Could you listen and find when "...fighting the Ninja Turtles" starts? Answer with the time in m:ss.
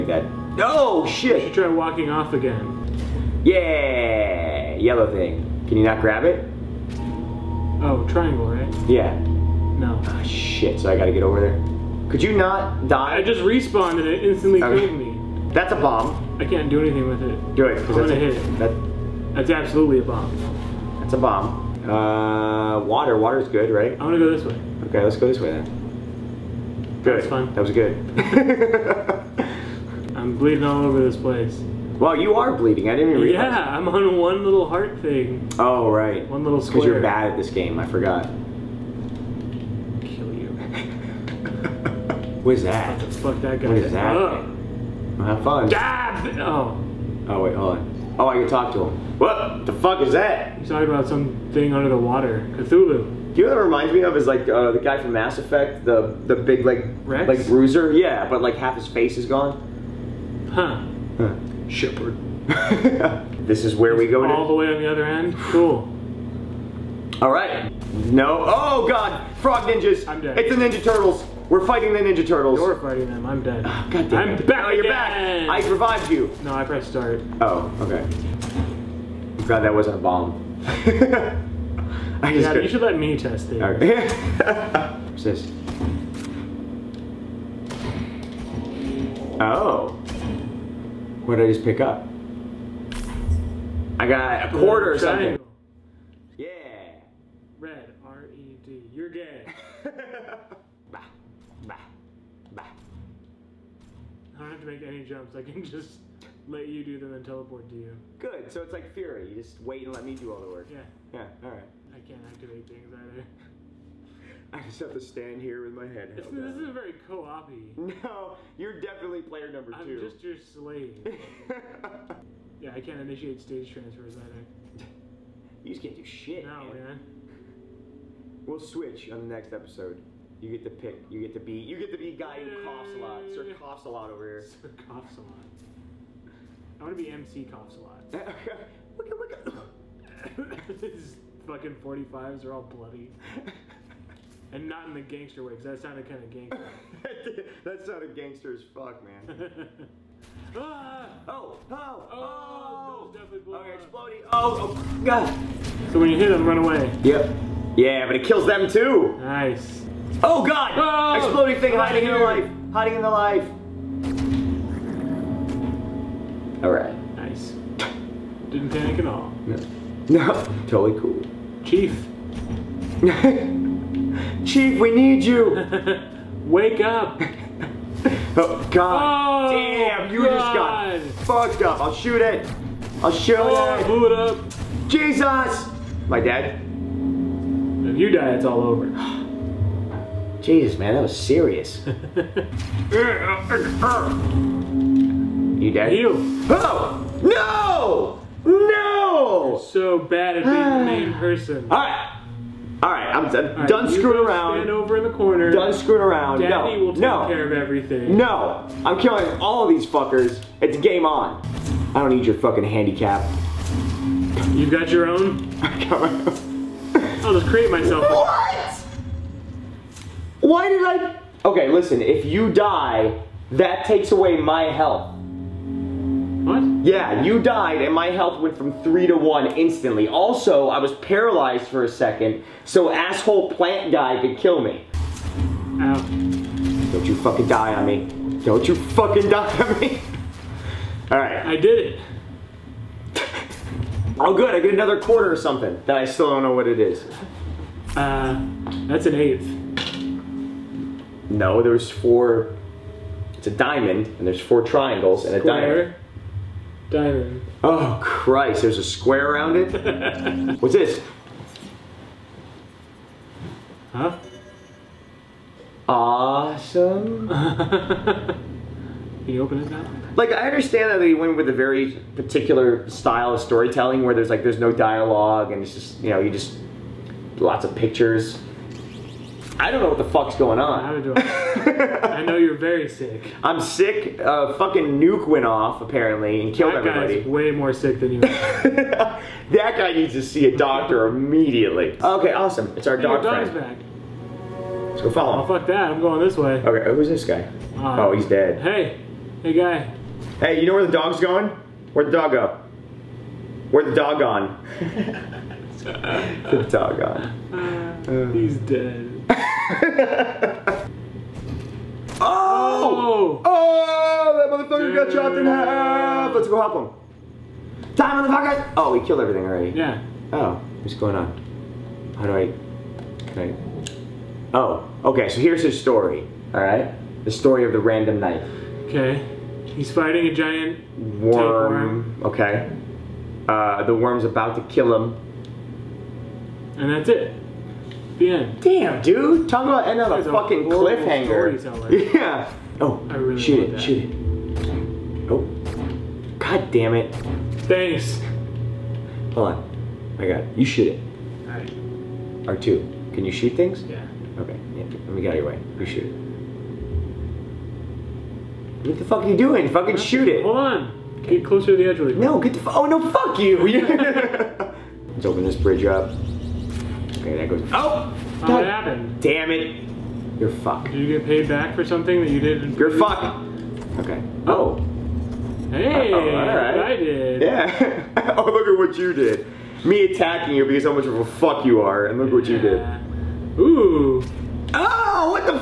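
1:11.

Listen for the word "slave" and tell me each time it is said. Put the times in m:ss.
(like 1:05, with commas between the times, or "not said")
2:00.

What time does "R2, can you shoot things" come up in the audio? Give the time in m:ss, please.
5:52.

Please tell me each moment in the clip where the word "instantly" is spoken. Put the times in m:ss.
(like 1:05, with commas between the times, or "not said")
0:14, 3:49.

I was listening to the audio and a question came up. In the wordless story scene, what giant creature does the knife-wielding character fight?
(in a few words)
a giant worm.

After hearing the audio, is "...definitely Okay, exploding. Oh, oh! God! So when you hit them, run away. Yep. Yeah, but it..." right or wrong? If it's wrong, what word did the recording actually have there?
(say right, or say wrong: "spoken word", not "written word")
right.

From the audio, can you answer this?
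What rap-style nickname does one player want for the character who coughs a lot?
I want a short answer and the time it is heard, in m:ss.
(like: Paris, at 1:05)
MC coughs a lot, at 2:17.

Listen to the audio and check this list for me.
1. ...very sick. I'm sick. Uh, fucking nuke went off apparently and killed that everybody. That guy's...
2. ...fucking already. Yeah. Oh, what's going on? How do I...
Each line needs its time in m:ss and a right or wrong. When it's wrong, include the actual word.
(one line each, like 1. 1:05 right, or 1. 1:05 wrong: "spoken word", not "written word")
1. 4:42 right
2. 5:19 wrong: "everything", not "fucking".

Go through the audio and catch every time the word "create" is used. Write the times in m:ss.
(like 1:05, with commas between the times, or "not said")
3:37.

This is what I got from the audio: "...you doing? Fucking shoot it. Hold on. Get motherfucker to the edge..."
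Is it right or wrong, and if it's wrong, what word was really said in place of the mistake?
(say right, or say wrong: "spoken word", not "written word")
wrong: "closer", not "motherfucker".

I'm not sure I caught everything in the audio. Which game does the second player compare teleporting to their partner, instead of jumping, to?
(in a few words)
Furi.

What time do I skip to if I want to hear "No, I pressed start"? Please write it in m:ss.
1:16.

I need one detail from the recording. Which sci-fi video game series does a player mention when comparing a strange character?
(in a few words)
Mass Effect.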